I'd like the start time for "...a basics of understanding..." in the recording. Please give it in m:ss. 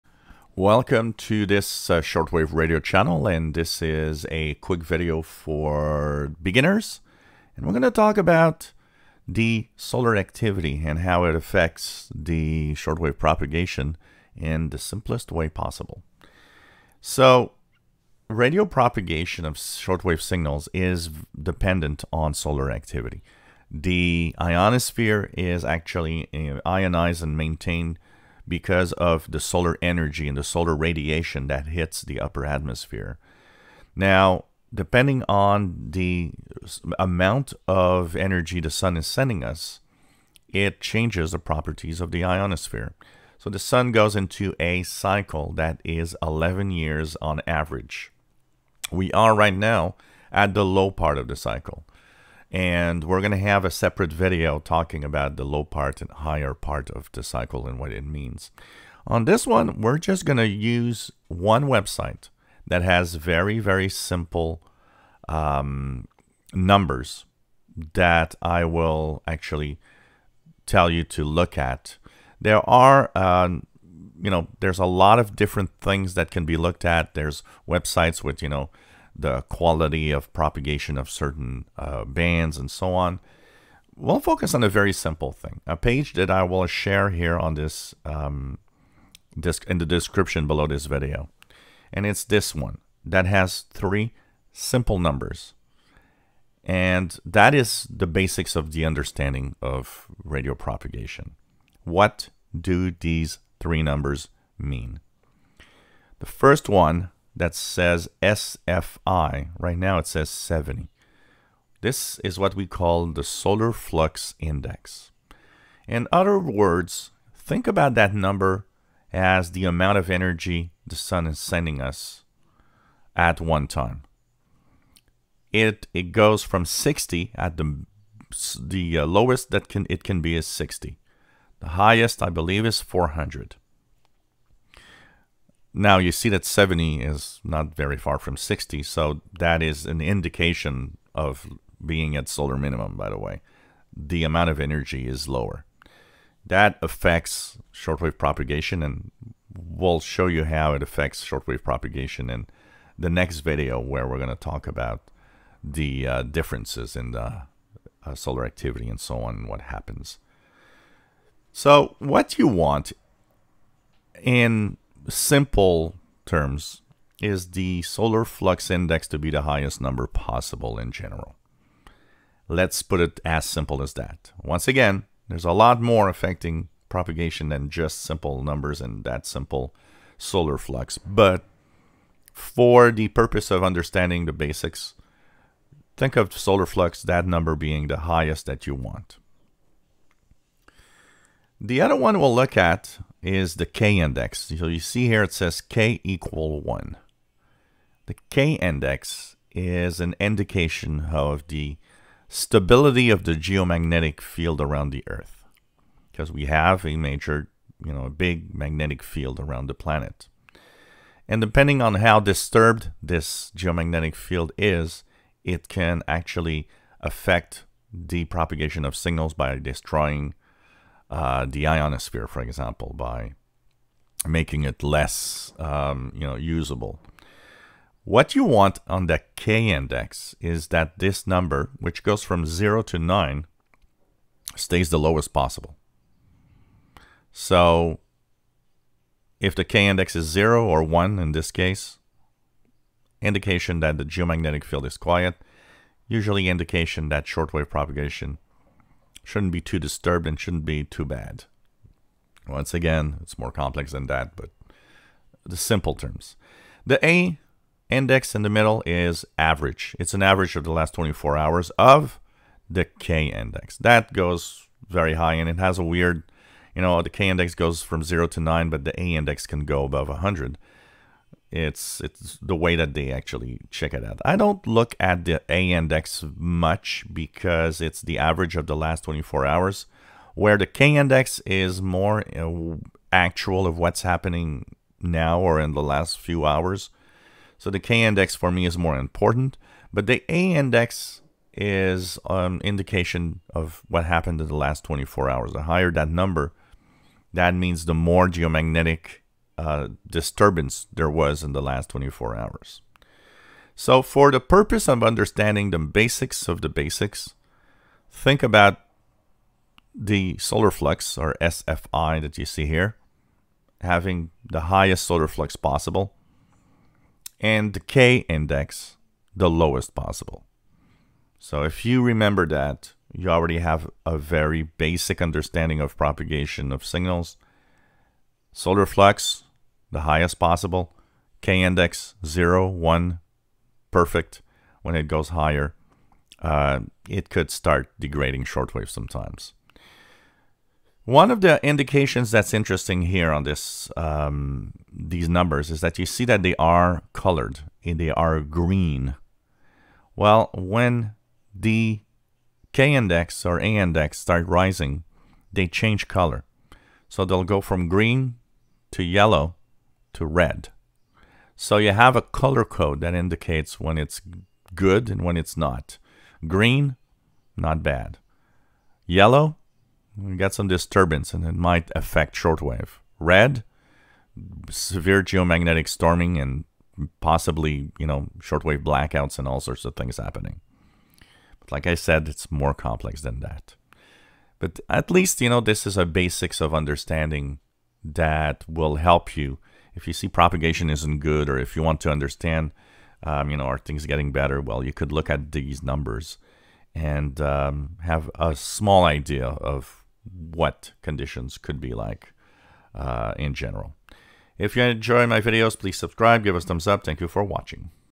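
6:25.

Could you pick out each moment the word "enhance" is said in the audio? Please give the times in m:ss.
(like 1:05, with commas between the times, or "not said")
not said.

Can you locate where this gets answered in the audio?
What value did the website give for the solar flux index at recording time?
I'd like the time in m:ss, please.
1:49.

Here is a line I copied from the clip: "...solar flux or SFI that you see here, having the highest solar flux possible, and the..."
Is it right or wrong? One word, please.
right.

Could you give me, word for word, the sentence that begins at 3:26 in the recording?
Because we have a major, you know, a big magnetic field around the planet.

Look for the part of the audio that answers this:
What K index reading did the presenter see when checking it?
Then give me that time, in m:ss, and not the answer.
3:15.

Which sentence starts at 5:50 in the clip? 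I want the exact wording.
Well, when the K index or A index start rising, they change color.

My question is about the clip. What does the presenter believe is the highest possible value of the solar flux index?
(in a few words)
400.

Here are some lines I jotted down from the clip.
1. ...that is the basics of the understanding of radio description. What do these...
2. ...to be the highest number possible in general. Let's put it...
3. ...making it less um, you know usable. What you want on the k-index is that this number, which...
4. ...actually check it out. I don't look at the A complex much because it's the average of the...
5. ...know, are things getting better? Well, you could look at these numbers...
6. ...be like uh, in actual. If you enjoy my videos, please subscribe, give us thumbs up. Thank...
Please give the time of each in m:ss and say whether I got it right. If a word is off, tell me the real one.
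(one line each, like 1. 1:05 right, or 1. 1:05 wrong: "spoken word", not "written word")
1. 1:37 wrong: "propagation", not "description"
2. 2:49 right
3. 3:44 right
4. 4:33 wrong: "index", not "complex"
5. 6:33 right
6. 6:41 wrong: "general", not "actual".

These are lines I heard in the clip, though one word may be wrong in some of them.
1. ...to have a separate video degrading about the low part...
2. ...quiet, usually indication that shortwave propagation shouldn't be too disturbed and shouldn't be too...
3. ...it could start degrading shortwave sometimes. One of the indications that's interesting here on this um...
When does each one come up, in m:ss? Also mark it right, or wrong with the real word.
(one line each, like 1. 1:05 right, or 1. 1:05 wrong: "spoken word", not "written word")
1. 0:53 wrong: "talking", not "degrading"
2. 4:04 right
3. 5:37 right.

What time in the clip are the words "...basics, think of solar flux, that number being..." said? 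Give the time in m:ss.
3:04.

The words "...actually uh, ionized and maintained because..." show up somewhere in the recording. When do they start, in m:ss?
0:25.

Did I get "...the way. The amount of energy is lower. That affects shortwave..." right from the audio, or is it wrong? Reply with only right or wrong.
right.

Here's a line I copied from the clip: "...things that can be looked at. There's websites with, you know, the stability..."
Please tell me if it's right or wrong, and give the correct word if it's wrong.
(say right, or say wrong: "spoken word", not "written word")
wrong: "quality", not "stability".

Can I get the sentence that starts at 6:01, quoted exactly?
So you have a color code that indicates when it's good and when it's not.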